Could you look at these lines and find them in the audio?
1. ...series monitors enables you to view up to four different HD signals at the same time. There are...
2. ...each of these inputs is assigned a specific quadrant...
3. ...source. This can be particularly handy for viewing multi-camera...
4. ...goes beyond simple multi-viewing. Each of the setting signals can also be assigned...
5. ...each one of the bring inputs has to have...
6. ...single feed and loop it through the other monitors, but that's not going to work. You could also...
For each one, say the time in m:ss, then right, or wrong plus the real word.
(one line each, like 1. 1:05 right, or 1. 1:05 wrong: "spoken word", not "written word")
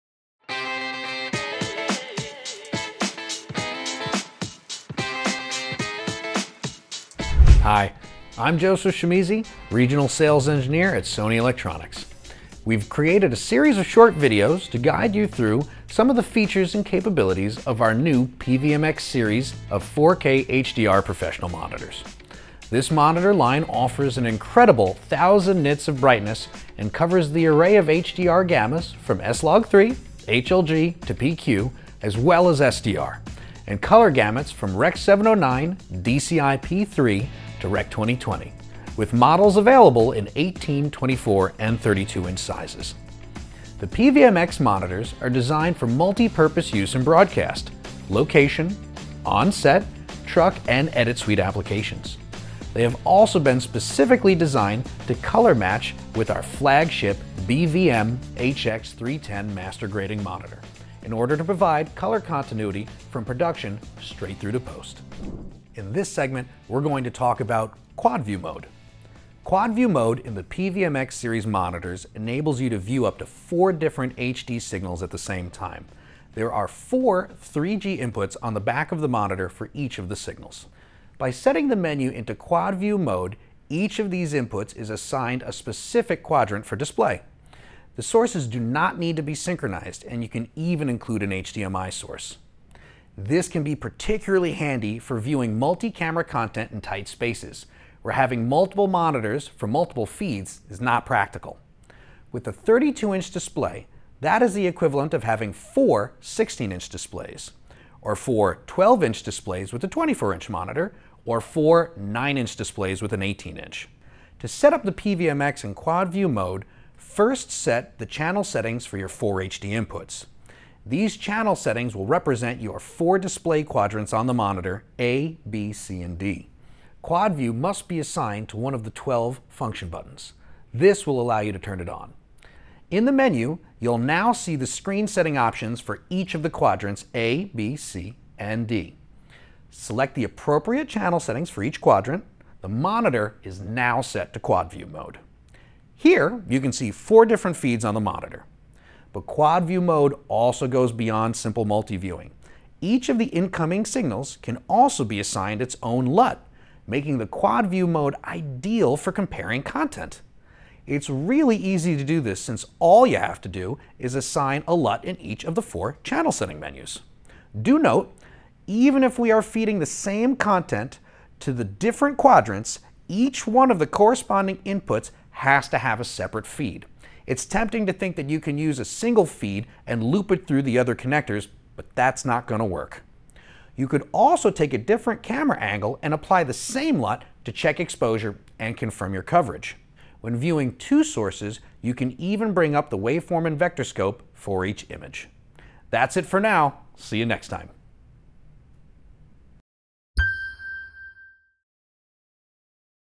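1. 1:11 right
2. 1:23 right
3. 1:31 right
4. 2:30 wrong: "incoming", not "setting"
5. 2:53 wrong: "corresponding", not "bring"
6. 2:58 wrong: "connectors", not "monitors".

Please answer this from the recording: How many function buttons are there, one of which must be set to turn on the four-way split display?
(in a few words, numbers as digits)
12.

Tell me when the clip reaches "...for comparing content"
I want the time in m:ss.
2:38.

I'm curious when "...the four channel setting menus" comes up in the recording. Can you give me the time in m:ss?
2:45.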